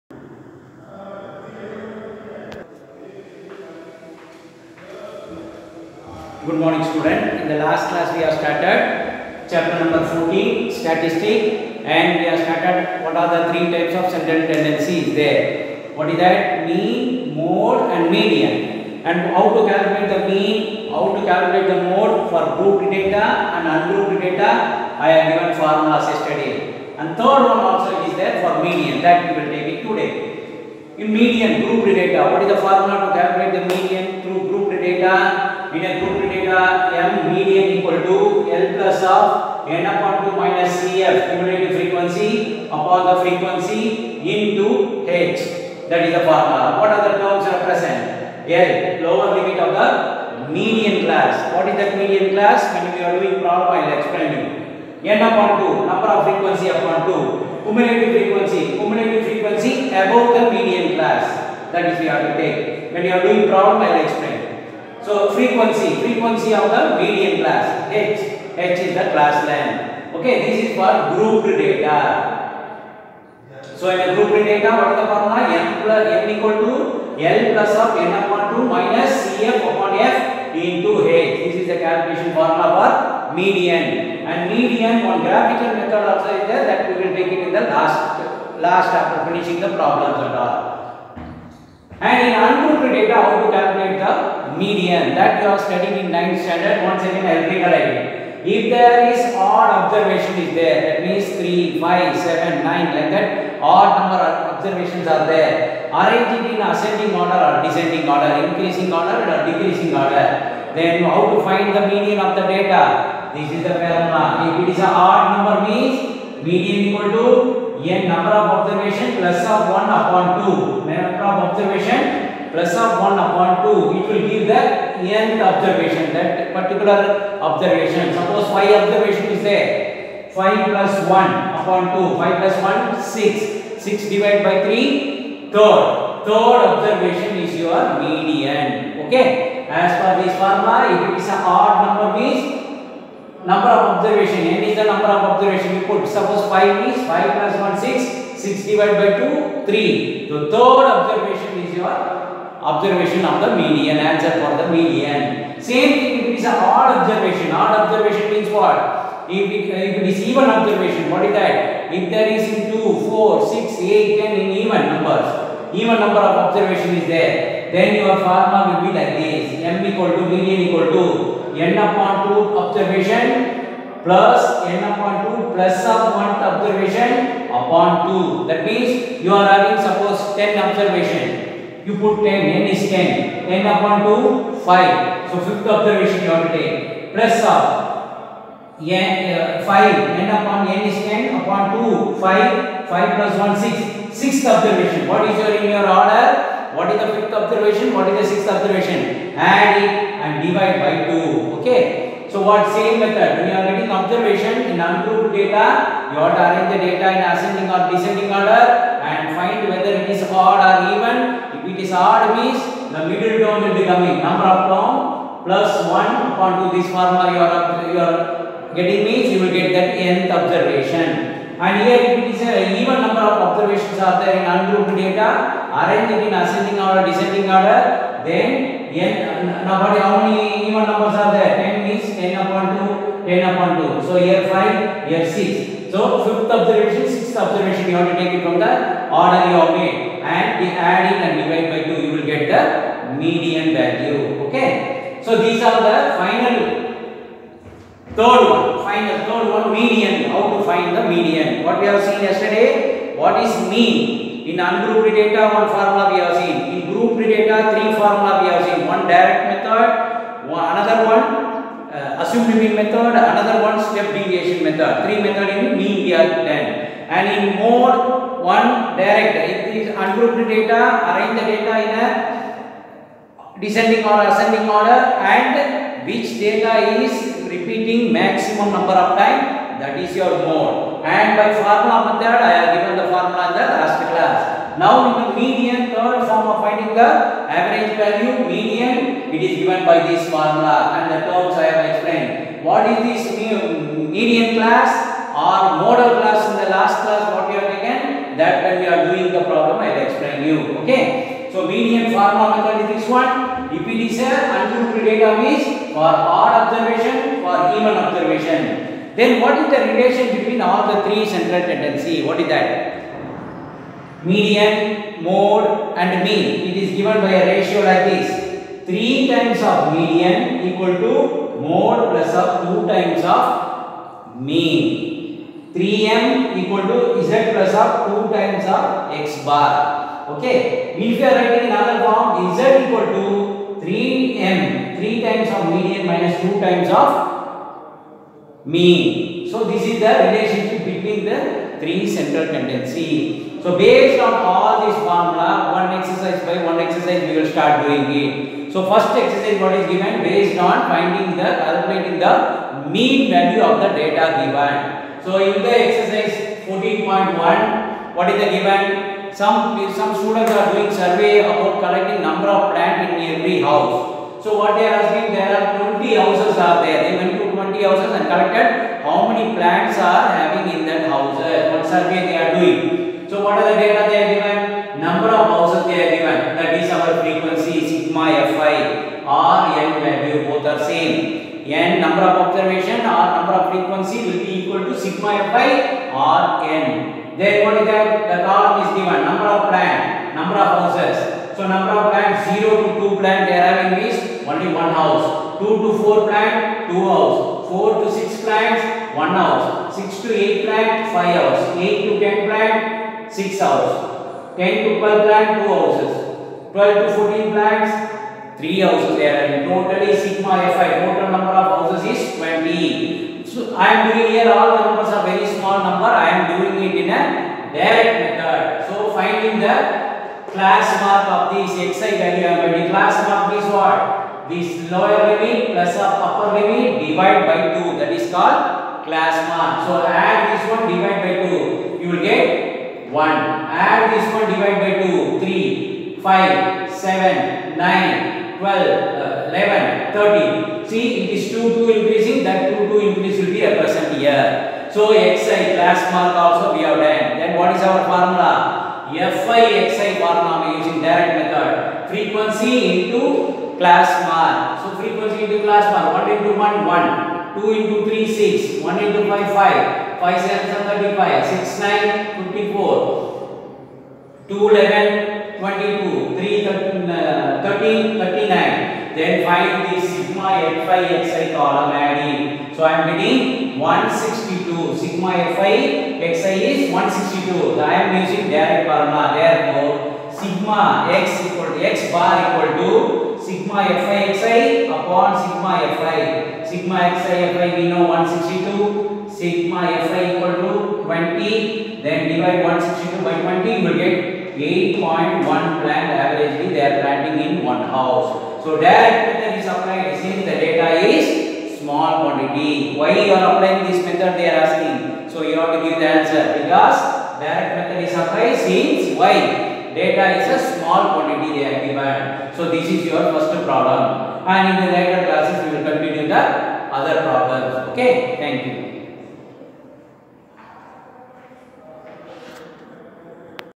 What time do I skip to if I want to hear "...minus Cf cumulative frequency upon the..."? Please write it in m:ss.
0:40.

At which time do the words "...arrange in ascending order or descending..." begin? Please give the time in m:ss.
1:46.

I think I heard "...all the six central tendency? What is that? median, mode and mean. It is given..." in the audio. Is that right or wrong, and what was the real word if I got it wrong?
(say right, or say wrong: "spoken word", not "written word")
wrong: "three", not "six".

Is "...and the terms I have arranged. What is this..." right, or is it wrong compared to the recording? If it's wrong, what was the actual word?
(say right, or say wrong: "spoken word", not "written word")
wrong: "explained", not "arranged".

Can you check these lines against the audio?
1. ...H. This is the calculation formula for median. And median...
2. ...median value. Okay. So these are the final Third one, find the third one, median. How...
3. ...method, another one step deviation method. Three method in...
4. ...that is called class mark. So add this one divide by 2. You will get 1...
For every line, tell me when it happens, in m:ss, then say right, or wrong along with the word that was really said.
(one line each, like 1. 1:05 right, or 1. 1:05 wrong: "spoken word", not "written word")
1. 1:21 right
2. 4:03 right
3. 4:22 right
4. 7:07 right.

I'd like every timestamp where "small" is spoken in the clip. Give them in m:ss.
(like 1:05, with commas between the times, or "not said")
6:55, 8:21, 8:30.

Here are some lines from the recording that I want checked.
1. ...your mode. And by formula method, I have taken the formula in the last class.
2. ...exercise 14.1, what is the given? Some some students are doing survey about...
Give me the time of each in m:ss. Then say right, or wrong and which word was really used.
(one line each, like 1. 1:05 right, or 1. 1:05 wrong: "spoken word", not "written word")
1. 4:40 wrong: "given", not "taken"
2. 5:55 right.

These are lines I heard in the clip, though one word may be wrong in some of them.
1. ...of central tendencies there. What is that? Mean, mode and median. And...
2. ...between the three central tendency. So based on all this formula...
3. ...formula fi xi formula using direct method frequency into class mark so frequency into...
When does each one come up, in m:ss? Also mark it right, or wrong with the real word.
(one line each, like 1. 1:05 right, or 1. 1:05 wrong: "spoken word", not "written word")
1. 0:14 right
2. 5:40 right
3. 7:28 right.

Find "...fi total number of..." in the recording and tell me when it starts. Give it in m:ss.
6:50.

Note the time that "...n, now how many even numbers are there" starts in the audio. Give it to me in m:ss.
3:49.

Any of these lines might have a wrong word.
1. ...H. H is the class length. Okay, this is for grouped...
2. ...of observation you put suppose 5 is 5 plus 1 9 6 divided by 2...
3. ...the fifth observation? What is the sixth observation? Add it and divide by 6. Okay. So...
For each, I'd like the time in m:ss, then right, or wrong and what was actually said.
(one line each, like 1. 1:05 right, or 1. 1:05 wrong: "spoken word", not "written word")
1. 1:07 right
2. 2:25 wrong: "6", not "9"
3. 3:17 wrong: "2", not "6".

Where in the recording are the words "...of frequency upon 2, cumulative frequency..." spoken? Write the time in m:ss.
0:56.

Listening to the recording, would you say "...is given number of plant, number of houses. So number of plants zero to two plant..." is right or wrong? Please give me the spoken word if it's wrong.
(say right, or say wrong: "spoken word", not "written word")
right.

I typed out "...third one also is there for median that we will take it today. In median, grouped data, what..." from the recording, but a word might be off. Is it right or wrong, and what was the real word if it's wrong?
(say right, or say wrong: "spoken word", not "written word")
right.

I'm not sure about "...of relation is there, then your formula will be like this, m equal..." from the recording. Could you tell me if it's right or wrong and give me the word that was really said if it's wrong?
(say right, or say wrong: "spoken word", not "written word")
wrong: "observation", not "relation".